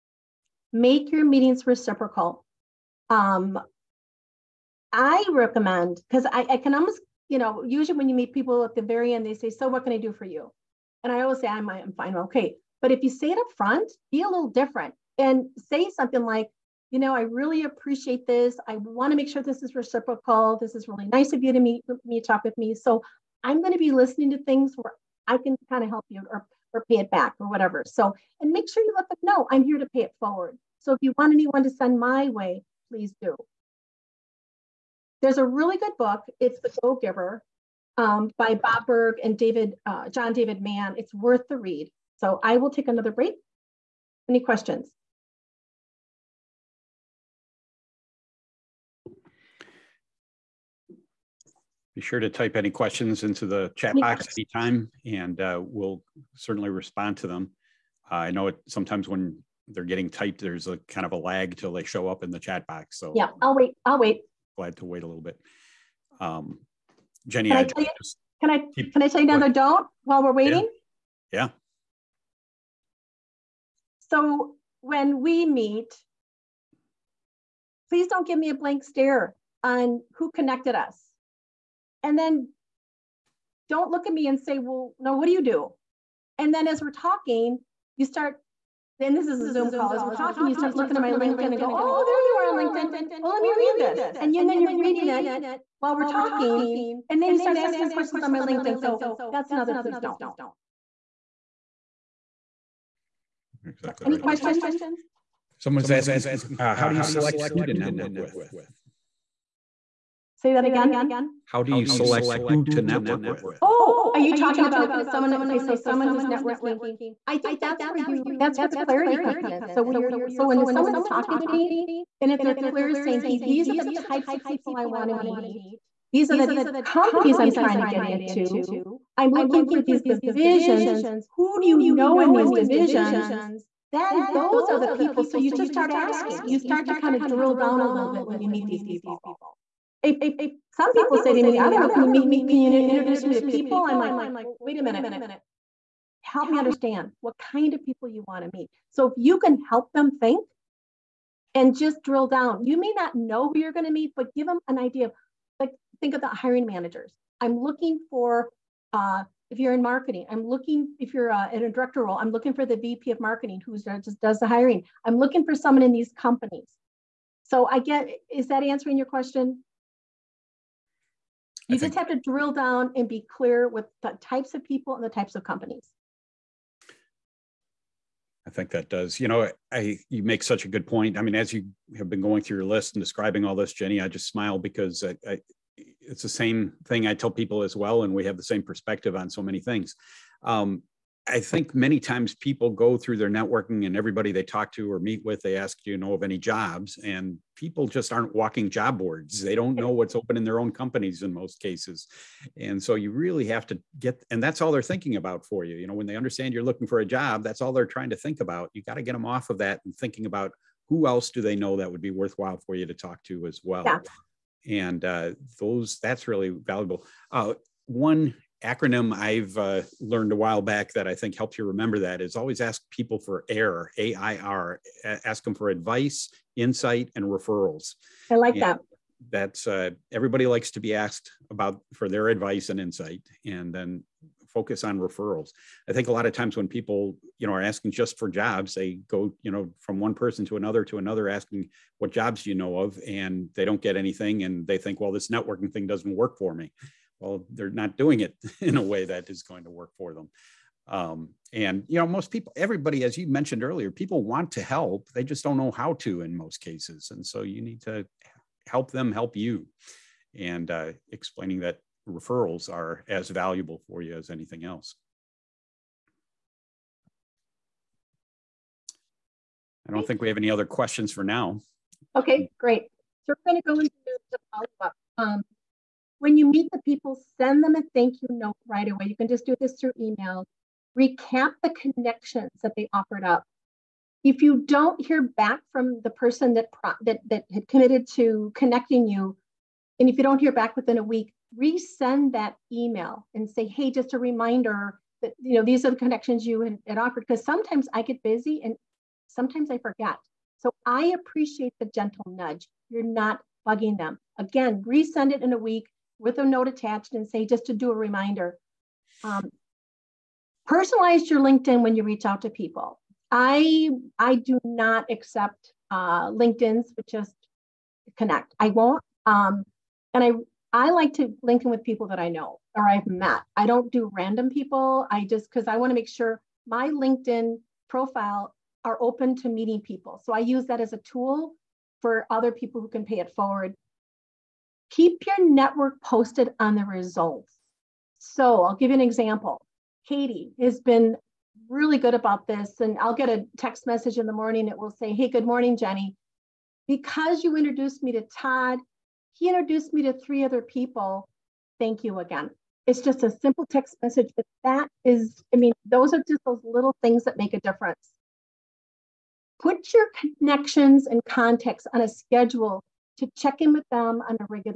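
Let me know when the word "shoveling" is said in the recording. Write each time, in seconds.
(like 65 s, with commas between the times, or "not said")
not said.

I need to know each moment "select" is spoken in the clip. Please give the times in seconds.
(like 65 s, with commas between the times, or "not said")
107 s, 111 s.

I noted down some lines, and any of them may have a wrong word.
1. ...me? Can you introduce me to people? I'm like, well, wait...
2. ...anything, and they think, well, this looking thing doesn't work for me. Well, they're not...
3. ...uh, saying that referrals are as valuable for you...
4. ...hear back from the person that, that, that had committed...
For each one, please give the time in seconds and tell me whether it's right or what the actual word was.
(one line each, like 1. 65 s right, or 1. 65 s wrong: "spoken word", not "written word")
1. 142 s right
2. 243 s wrong: "networking", not "looking"
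3. 260 s wrong: "explaining", not "saying"
4. 285 s right.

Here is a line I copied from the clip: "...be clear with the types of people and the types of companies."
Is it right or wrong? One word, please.
right.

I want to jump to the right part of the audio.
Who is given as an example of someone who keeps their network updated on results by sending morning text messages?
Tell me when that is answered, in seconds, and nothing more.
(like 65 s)
340 s.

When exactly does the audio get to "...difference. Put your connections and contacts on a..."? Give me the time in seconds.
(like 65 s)
357 s.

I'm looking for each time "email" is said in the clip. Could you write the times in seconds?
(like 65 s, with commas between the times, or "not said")
279 s, 292 s.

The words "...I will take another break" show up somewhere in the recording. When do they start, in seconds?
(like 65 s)
42 s.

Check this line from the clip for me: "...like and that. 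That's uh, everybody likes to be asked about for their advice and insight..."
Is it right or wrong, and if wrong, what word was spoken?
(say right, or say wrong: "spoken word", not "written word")
right.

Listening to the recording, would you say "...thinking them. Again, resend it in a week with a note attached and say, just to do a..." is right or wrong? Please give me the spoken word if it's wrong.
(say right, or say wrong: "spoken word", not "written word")
wrong: "bugging", not "thinking".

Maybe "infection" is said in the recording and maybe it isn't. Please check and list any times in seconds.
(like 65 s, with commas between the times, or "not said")
not said.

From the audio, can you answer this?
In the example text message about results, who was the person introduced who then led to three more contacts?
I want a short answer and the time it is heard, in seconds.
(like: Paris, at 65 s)
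Todd, at 348 s.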